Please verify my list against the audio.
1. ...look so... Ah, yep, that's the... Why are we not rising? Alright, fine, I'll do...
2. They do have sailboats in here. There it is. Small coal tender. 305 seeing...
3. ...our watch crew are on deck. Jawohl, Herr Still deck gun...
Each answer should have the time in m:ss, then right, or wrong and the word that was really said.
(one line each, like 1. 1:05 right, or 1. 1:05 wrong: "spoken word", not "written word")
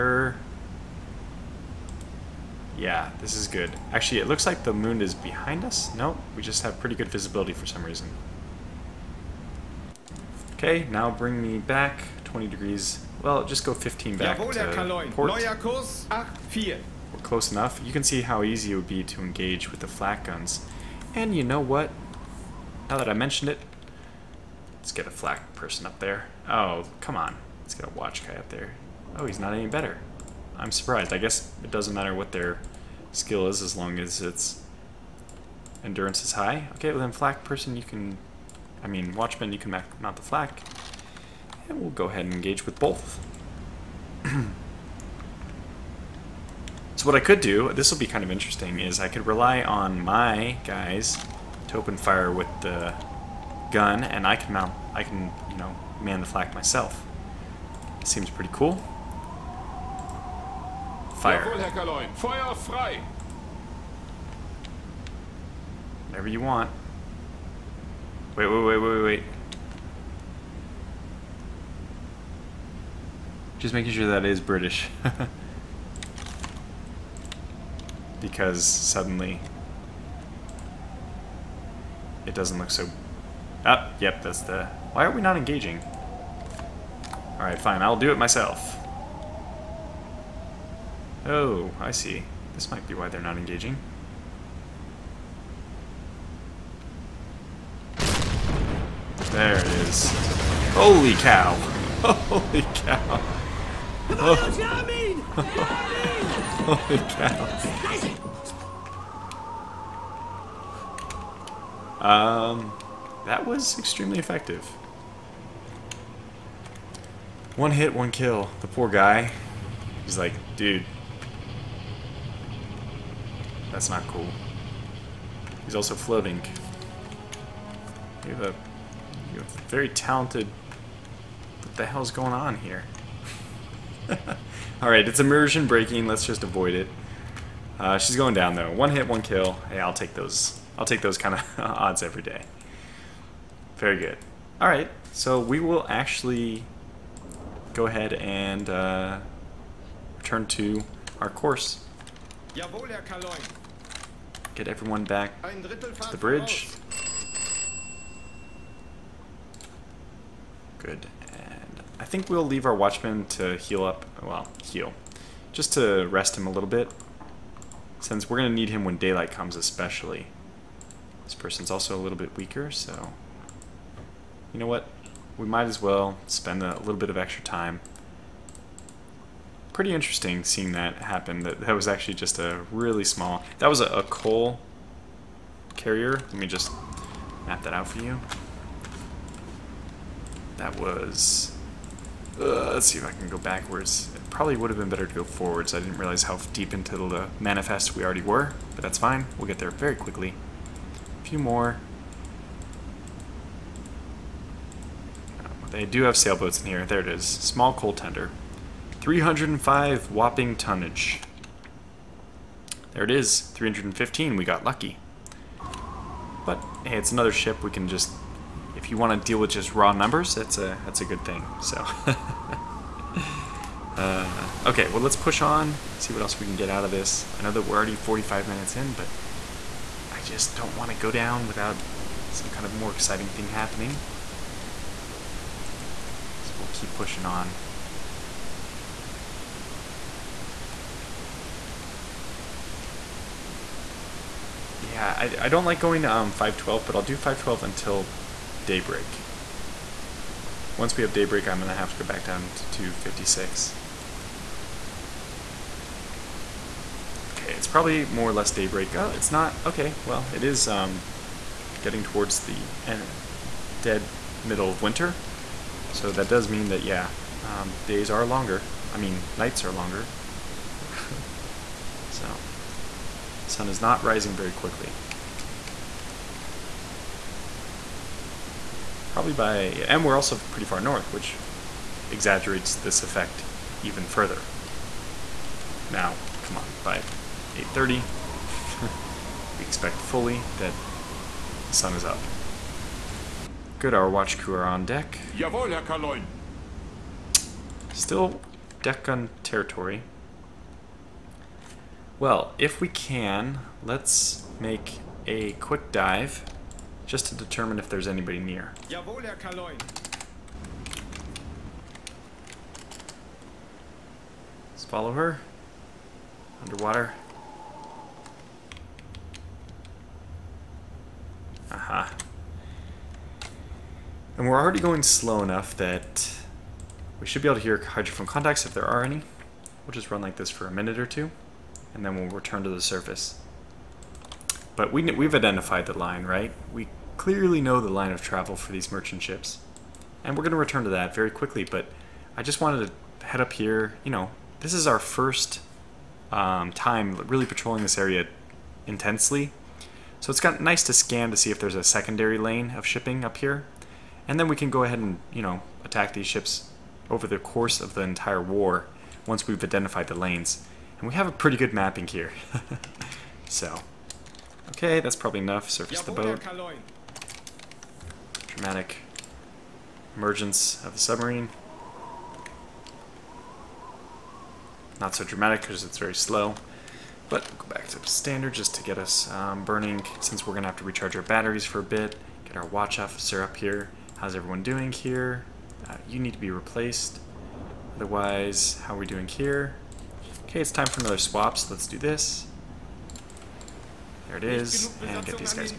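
1. 1:22 wrong: "engaging", not "rising"
2. 3:25 wrong: "whopping", not "seeing"
3. 4:53 right.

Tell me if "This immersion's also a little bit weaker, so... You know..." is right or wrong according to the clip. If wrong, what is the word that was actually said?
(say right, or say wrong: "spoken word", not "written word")
wrong: "person", not "immersion".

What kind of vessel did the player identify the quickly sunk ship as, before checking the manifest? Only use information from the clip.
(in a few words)
A coal carrier.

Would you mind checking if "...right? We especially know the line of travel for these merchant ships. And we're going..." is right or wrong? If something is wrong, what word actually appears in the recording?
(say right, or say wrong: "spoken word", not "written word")
wrong: "clearly", not "especially".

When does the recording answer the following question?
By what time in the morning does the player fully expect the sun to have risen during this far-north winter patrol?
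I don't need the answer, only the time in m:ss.
4:47.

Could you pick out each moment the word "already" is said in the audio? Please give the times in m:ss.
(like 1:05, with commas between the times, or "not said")
3:18, 3:47, 5:24.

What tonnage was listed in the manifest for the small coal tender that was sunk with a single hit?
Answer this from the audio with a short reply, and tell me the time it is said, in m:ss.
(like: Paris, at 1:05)
315, at 3:33.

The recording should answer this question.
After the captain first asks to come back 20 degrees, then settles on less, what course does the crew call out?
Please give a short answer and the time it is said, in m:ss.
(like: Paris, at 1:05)
84, at 0:16.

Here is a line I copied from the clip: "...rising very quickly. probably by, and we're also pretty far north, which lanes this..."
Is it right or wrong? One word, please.
wrong.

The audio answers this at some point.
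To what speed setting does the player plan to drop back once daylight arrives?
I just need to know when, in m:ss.
4:12.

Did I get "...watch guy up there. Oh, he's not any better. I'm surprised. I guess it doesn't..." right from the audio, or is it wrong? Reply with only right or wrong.
right.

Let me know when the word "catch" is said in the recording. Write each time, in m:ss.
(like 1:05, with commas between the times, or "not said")
not said.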